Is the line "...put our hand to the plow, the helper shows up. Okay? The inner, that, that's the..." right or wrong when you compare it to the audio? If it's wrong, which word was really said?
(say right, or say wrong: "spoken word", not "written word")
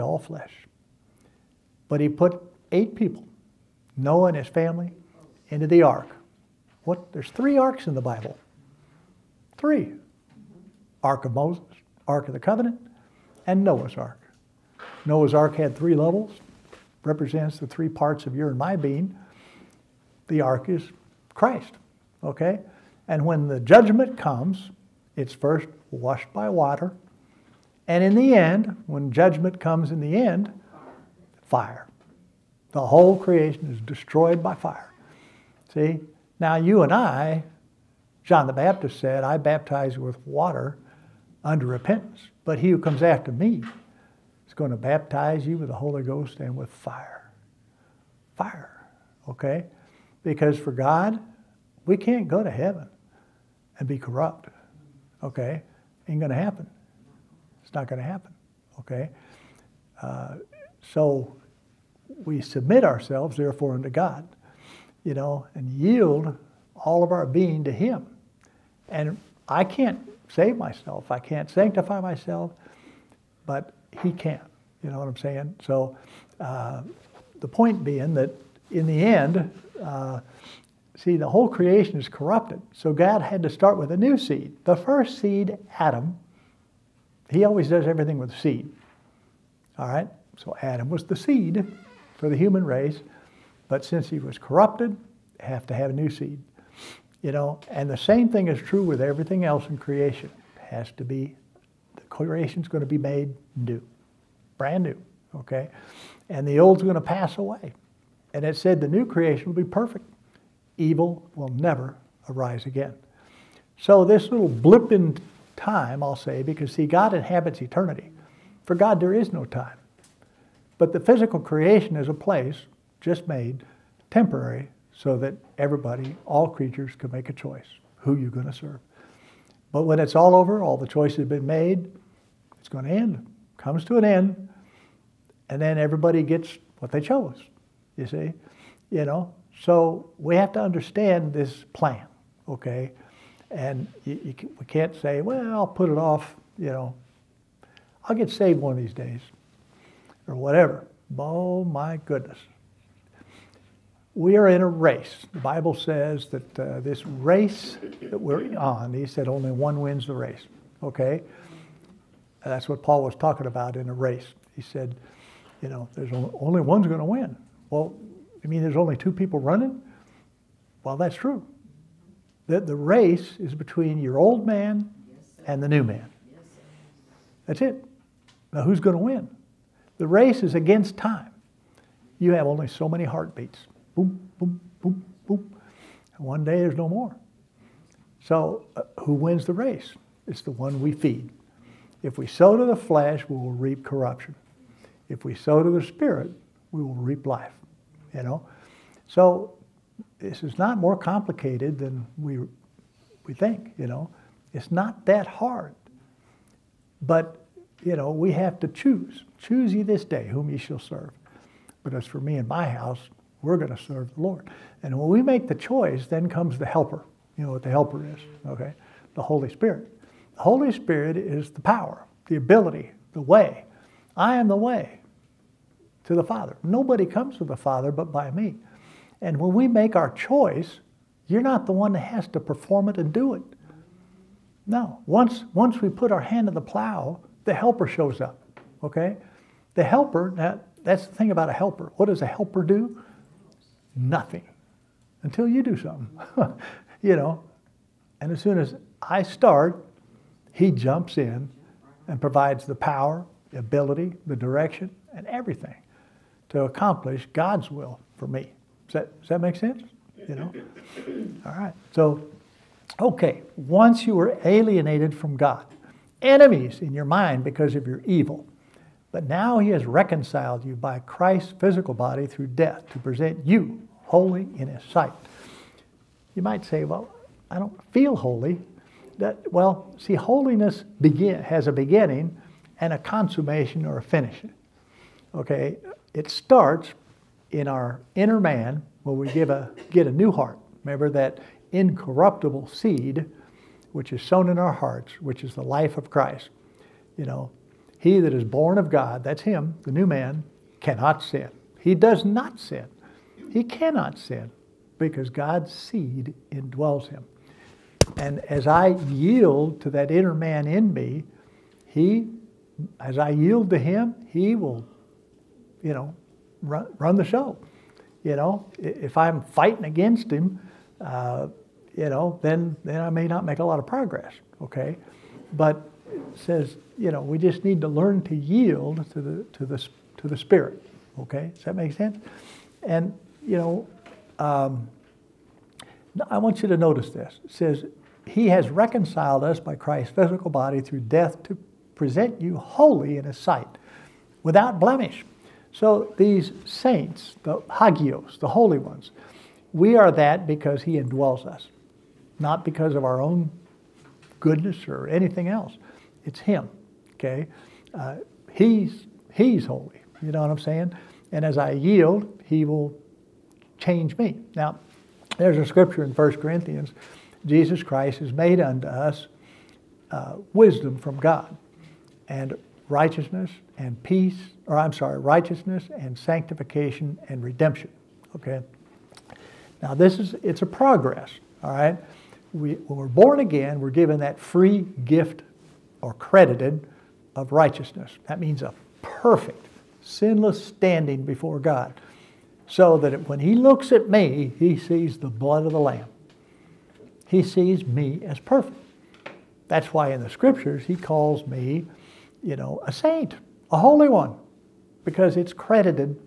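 wrong: "helper", not "inner".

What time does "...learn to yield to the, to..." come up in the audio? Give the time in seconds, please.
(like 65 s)
327 s.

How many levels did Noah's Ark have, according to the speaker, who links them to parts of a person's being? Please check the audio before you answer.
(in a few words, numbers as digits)
3.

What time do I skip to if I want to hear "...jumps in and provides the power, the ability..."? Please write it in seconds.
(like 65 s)
250 s.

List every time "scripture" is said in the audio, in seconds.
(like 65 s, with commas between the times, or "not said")
365 s, 400 s.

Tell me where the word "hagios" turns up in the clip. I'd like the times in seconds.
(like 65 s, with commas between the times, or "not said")
347 s.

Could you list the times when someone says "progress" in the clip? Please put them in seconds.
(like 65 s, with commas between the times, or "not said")
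323 s, 380 s.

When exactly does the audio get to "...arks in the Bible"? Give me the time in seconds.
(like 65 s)
7 s.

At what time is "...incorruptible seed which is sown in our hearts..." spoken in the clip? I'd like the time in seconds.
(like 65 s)
291 s.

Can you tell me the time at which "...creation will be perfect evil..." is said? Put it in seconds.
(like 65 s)
109 s.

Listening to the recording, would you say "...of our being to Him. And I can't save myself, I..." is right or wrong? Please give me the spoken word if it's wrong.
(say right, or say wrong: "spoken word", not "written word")
right.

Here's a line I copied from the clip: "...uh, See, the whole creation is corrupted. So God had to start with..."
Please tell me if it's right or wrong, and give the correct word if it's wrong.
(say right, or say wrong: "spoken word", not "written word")
right.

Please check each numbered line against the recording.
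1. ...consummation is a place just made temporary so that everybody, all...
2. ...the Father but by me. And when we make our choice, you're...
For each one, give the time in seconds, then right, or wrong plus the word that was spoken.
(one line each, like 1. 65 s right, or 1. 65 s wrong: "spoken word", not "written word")
1. 121 s wrong: "creation", not "consummation"
2. 227 s right.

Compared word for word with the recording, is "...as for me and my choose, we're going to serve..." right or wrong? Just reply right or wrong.
wrong.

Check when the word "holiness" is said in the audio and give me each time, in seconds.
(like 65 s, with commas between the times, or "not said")
280 s.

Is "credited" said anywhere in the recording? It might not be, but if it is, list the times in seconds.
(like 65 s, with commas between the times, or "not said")
386 s, 405 s.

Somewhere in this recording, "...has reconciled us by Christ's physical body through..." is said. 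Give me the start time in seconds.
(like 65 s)
338 s.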